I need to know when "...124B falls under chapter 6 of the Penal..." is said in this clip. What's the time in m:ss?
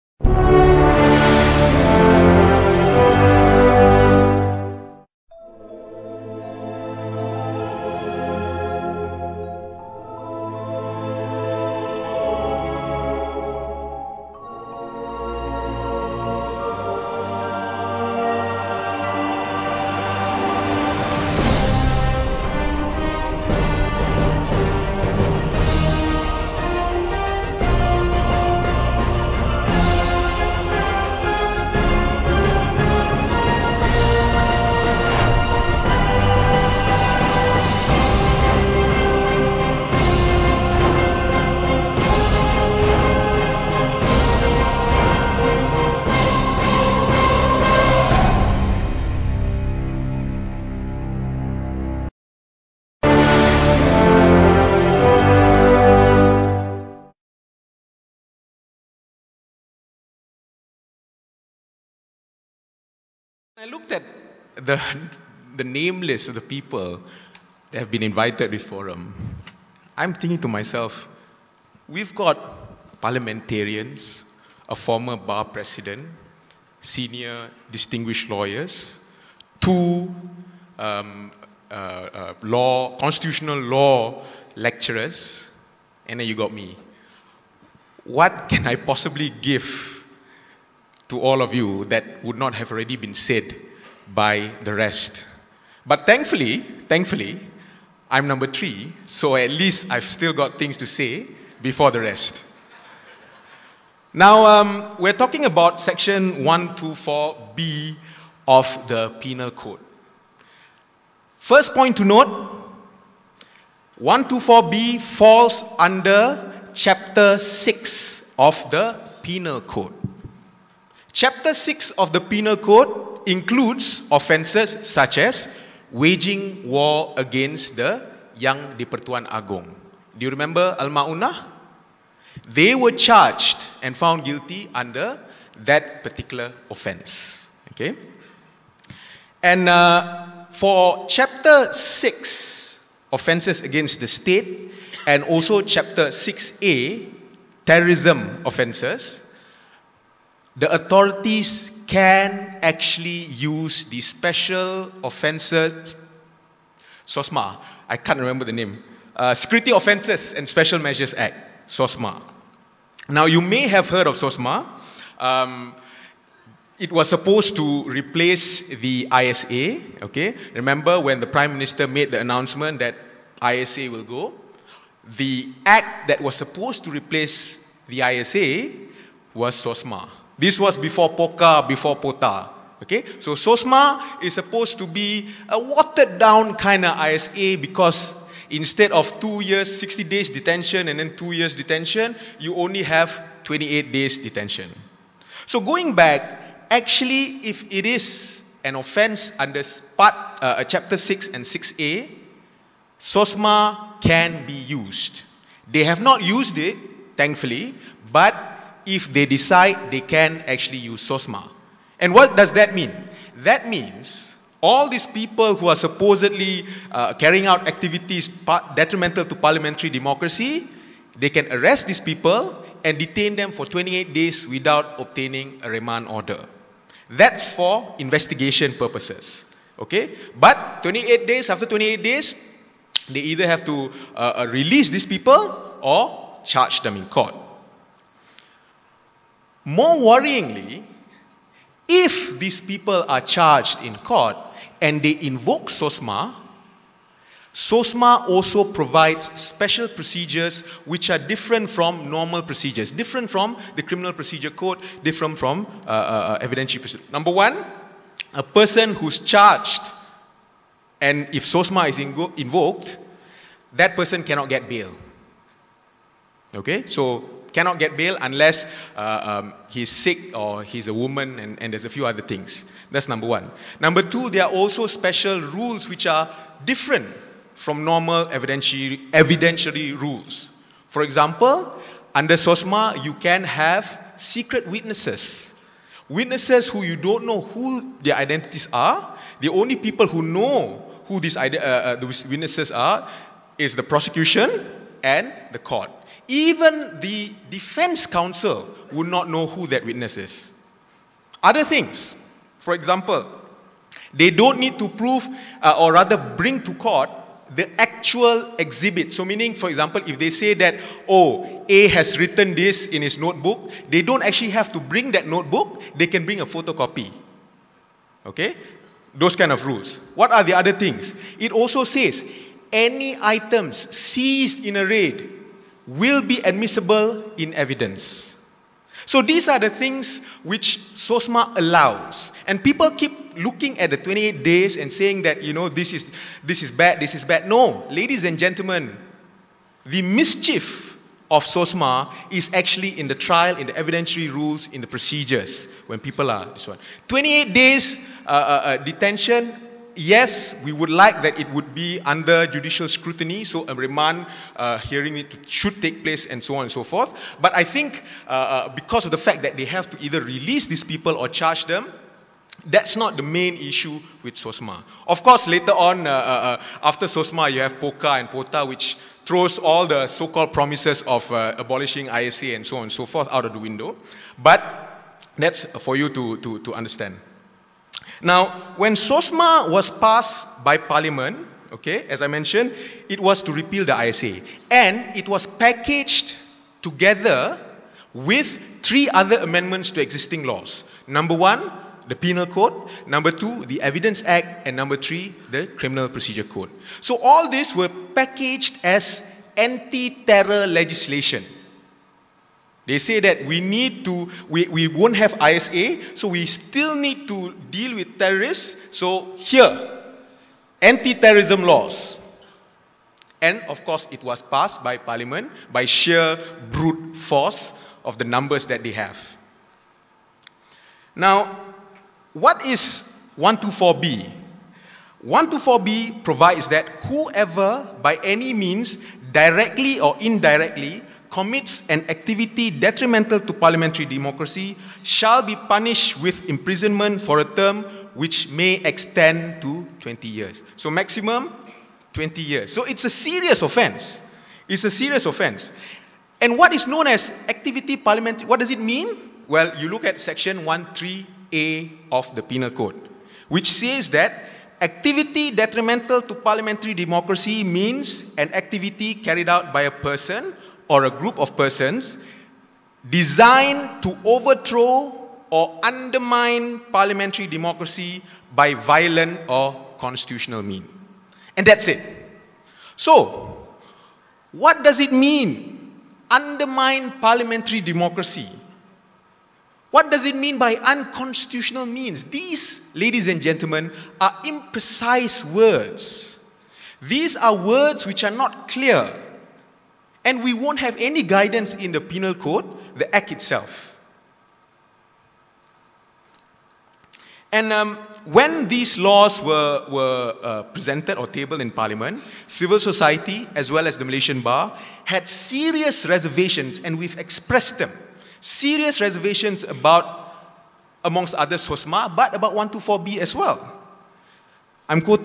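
1:54.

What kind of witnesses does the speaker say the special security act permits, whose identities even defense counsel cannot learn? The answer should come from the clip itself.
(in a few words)
Secret witnesses.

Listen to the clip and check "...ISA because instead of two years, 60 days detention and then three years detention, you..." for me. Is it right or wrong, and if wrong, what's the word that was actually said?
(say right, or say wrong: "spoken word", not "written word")
wrong: "two", not "three".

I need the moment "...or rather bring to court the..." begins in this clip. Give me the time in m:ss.
5:05.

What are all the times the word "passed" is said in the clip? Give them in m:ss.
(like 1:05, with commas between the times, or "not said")
6:19, 6:54.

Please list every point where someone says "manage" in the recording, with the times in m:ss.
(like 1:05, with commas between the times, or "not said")
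not said.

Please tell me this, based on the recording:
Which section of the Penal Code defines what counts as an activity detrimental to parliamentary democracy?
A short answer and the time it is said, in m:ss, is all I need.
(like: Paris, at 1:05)
Section 13A, at 7:30.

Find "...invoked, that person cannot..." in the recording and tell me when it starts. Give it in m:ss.
4:22.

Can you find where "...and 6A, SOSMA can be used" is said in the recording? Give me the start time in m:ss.
3:21.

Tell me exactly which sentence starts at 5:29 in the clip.
So these are the things which SOSMA allows.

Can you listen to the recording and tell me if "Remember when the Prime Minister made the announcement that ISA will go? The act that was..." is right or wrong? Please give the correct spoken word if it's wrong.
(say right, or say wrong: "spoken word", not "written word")
right.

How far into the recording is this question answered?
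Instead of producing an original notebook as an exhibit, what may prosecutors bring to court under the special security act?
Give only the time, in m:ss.
5:16.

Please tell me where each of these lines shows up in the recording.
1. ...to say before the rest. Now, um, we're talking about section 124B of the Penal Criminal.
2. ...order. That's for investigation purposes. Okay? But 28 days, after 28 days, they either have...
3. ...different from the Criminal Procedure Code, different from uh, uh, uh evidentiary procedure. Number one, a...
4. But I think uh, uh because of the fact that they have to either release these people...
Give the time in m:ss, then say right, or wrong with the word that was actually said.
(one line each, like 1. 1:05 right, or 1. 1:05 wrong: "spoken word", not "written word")
1. 1:40 wrong: "Code", not "Criminal"
2. 3:46 right
3. 4:12 right
4. 5:57 right.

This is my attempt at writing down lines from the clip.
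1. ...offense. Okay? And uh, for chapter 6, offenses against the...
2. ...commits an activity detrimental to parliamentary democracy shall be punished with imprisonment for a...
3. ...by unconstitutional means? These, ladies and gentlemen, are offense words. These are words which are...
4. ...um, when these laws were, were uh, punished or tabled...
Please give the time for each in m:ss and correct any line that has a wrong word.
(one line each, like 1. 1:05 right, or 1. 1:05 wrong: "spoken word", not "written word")
1. 2:16 right
2. 7:11 right
3. 8:00 wrong: "imprecise", not "offense"
4. 8:17 wrong: "presented", not "punished".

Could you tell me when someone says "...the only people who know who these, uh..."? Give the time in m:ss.
4:49.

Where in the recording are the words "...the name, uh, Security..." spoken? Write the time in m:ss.
2:38.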